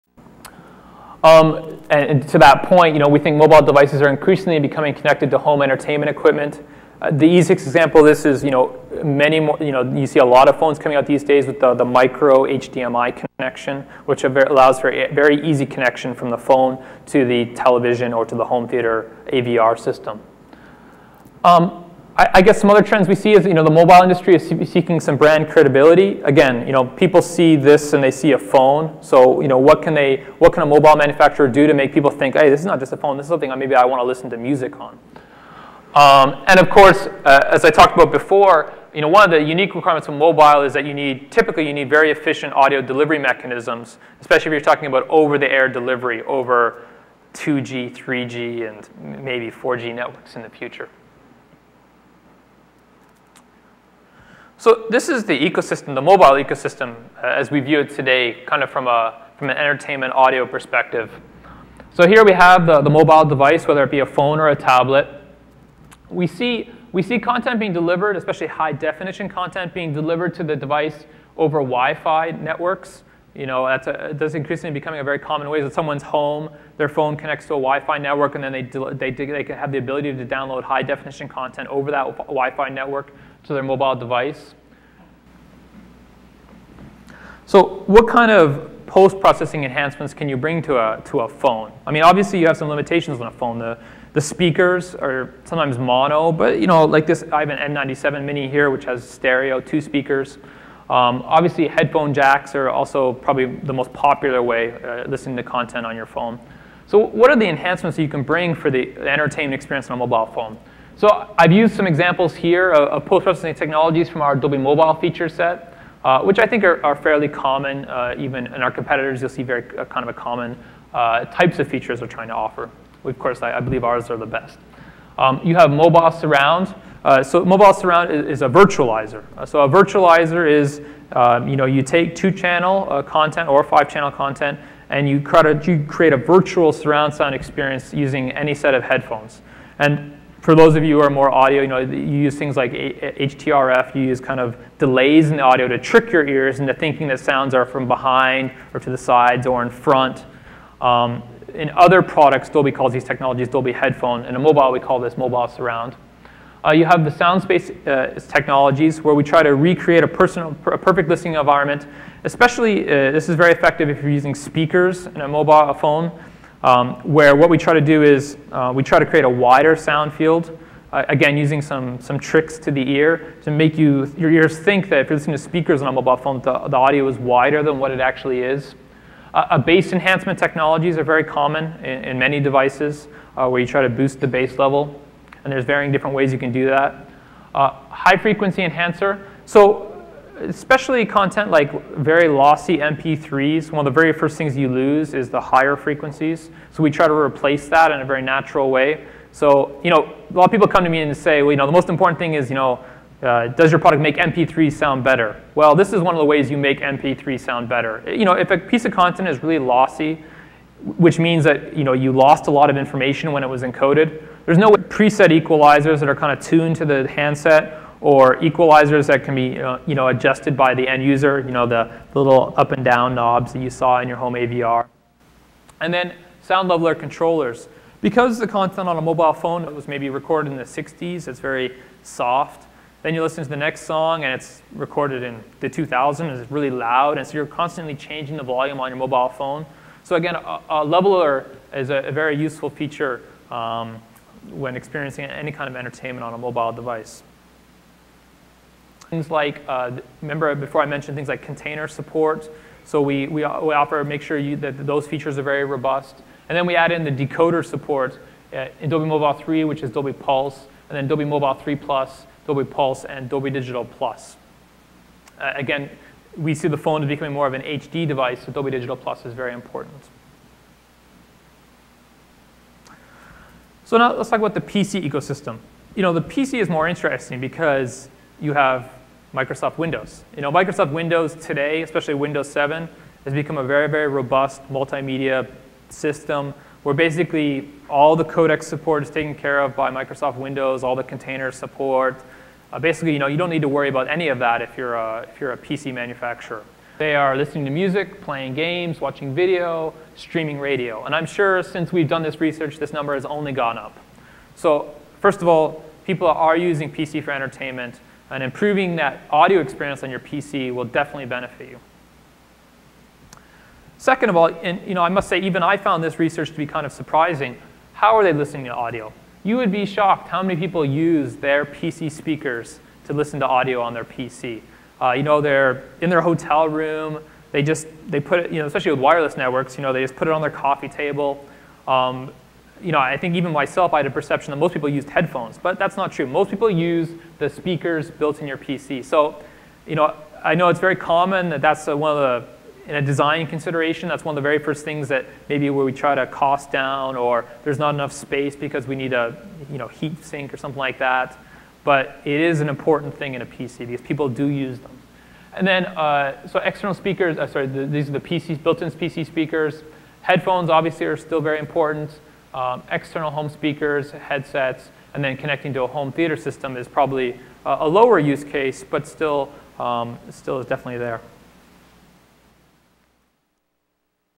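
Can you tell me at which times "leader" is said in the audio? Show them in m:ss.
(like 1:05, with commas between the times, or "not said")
not said.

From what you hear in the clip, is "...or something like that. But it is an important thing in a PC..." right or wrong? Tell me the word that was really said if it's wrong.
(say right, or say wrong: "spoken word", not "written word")
right.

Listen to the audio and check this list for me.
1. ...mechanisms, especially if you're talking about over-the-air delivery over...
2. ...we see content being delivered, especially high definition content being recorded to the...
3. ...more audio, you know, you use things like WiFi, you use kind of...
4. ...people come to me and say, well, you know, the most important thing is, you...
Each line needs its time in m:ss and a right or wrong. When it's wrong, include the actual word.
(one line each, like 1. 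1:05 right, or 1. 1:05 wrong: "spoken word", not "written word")
1. 0:43 right
2. 1:06 wrong: "delivered", not "recorded"
3. 2:21 wrong: "HTRF", not "WiFi"
4. 3:20 right.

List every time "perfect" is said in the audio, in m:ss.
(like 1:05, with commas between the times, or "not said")
2:40.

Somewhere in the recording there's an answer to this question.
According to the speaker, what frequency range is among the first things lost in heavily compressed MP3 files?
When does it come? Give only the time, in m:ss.
3:15.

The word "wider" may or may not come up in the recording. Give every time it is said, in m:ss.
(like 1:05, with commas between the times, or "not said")
2:49, 2:57.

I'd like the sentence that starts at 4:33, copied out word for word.
So now let's talk about the PC ecosystem.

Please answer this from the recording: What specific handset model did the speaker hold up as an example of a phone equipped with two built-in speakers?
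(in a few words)
N97 mini.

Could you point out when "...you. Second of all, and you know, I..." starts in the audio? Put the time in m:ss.
5:11.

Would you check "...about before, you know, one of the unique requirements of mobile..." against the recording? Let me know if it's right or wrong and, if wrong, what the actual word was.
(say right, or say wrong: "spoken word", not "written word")
right.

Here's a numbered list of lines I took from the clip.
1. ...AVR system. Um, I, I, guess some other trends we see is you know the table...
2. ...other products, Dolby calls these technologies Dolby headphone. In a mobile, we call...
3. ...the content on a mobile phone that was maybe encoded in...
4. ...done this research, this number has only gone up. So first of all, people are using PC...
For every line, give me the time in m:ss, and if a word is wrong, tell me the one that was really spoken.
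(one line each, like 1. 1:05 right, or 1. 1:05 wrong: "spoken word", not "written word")
1. 0:19 wrong: "mobile", not "table"
2. 2:31 right
3. 3:48 wrong: "recorded", not "encoded"
4. 5:02 right.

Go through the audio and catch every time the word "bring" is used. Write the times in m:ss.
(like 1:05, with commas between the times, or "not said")
1:30, 1:48.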